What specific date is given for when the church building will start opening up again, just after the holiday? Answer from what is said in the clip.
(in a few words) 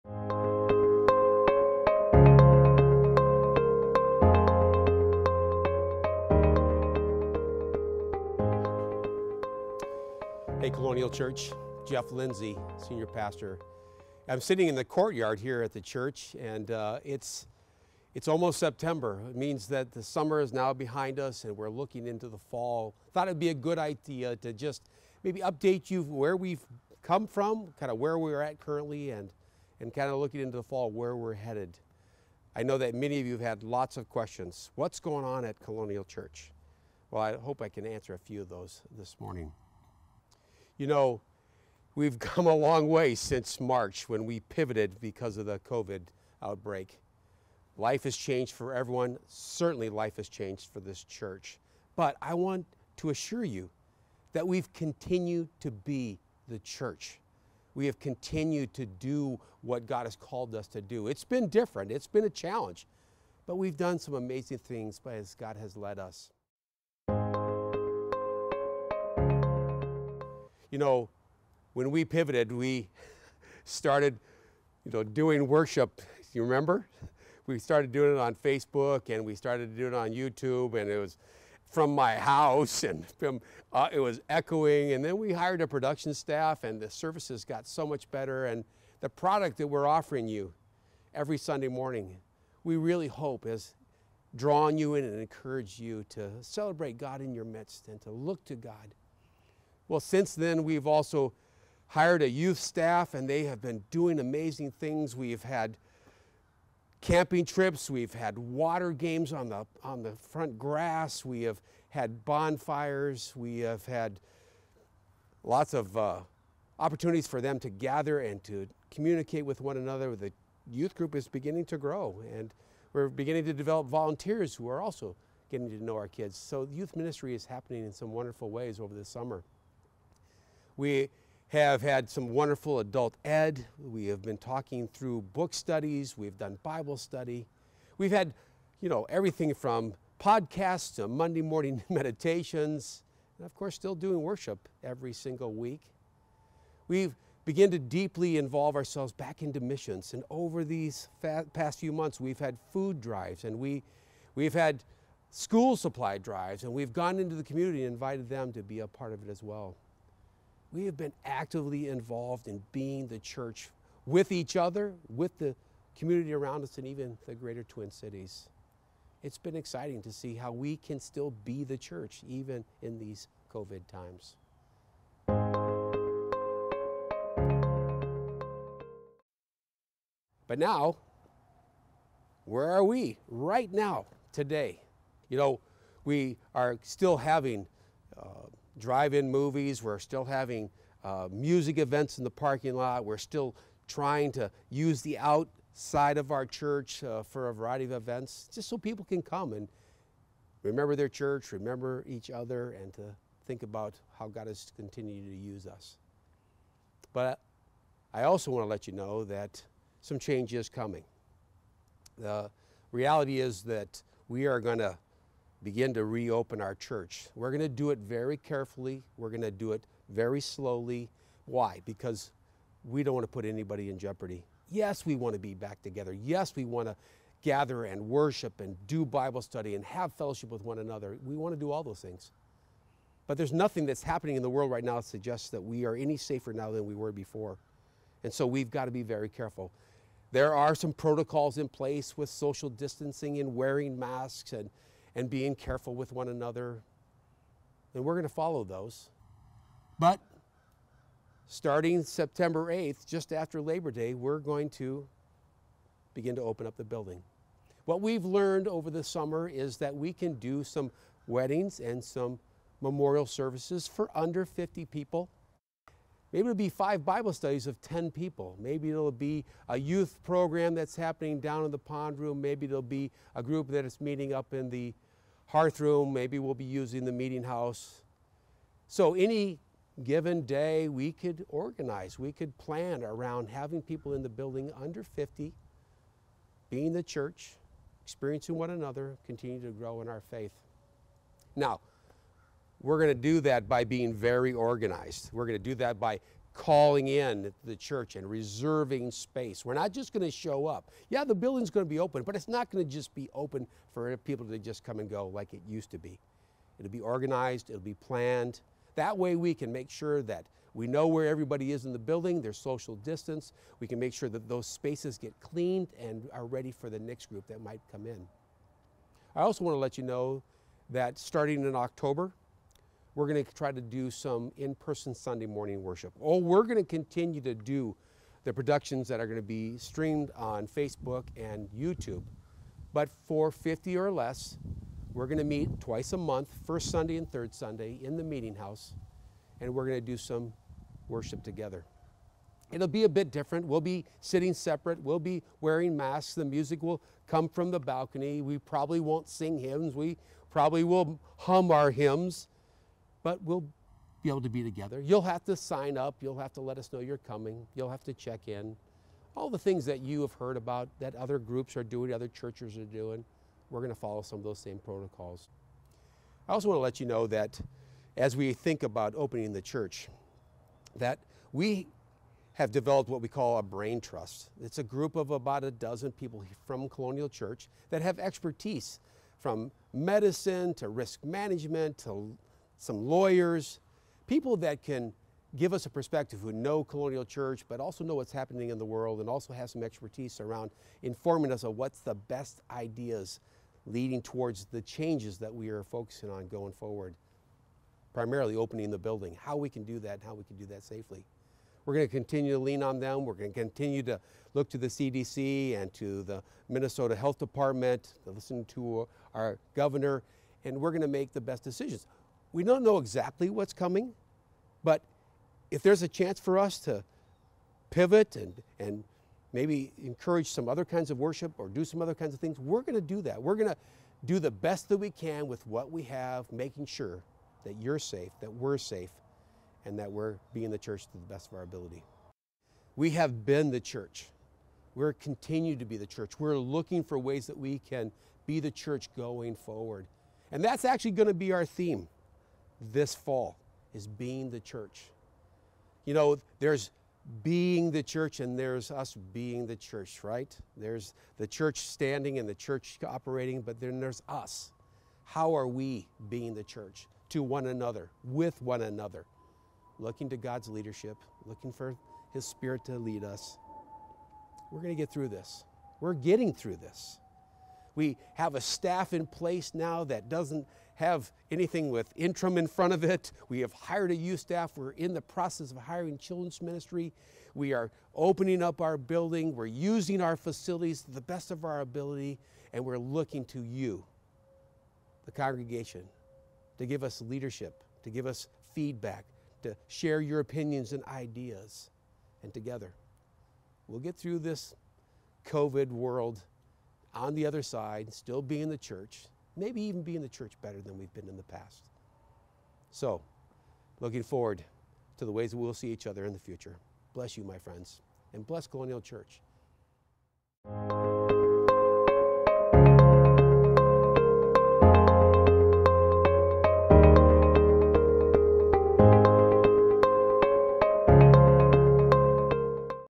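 September 8th.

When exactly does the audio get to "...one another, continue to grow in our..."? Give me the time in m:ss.
4:48.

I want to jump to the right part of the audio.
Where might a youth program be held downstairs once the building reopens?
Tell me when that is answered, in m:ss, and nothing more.
4:31.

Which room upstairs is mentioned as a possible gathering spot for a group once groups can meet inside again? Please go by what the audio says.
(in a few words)
the hearth room.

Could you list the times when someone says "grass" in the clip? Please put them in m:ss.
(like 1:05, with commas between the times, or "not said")
1:50.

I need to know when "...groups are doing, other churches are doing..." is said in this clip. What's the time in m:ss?
6:01.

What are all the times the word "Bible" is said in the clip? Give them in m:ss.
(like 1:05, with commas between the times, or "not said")
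2:16, 3:49, 4:27.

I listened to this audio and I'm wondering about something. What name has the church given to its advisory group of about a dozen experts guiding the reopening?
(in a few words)
brain trust.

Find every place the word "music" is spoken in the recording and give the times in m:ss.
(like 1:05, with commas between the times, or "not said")
3:11, 5:46.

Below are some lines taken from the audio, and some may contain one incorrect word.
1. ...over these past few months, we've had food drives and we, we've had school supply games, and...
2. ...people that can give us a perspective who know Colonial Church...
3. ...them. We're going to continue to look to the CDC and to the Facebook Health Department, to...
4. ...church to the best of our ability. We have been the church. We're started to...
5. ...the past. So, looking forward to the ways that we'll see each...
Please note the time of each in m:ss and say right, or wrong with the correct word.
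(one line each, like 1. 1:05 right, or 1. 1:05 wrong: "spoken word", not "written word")
1. 2:30 wrong: "drives", not "games"
2. 6:24 right
3. 6:42 wrong: "Minnesota", not "Facebook"
4. 7:10 wrong: "continued", not "started"
5. 8:21 right.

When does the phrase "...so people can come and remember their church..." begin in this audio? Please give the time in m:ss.
3:18.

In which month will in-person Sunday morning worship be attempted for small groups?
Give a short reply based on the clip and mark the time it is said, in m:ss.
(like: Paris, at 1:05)
October, at 5:21.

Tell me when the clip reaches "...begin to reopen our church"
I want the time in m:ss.
3:35.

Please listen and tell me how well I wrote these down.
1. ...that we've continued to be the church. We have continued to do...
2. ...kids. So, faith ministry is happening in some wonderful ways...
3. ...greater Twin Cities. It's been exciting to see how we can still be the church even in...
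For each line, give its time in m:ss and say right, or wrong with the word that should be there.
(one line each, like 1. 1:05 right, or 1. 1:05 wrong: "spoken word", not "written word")
1. 0:54 right
2. 2:06 wrong: "youth", not "faith"
3. 2:47 right.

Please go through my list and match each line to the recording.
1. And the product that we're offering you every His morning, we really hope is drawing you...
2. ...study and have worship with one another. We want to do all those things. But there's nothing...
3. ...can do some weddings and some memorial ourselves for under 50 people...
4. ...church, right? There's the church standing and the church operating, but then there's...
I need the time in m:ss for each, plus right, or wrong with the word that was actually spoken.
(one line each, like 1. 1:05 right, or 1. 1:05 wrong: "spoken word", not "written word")
1. 1:28 wrong: "Sunday", not "His"
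2. 3:49 wrong: "fellowship", not "worship"
3. 4:20 wrong: "services", not "ourselves"
4. 7:29 right.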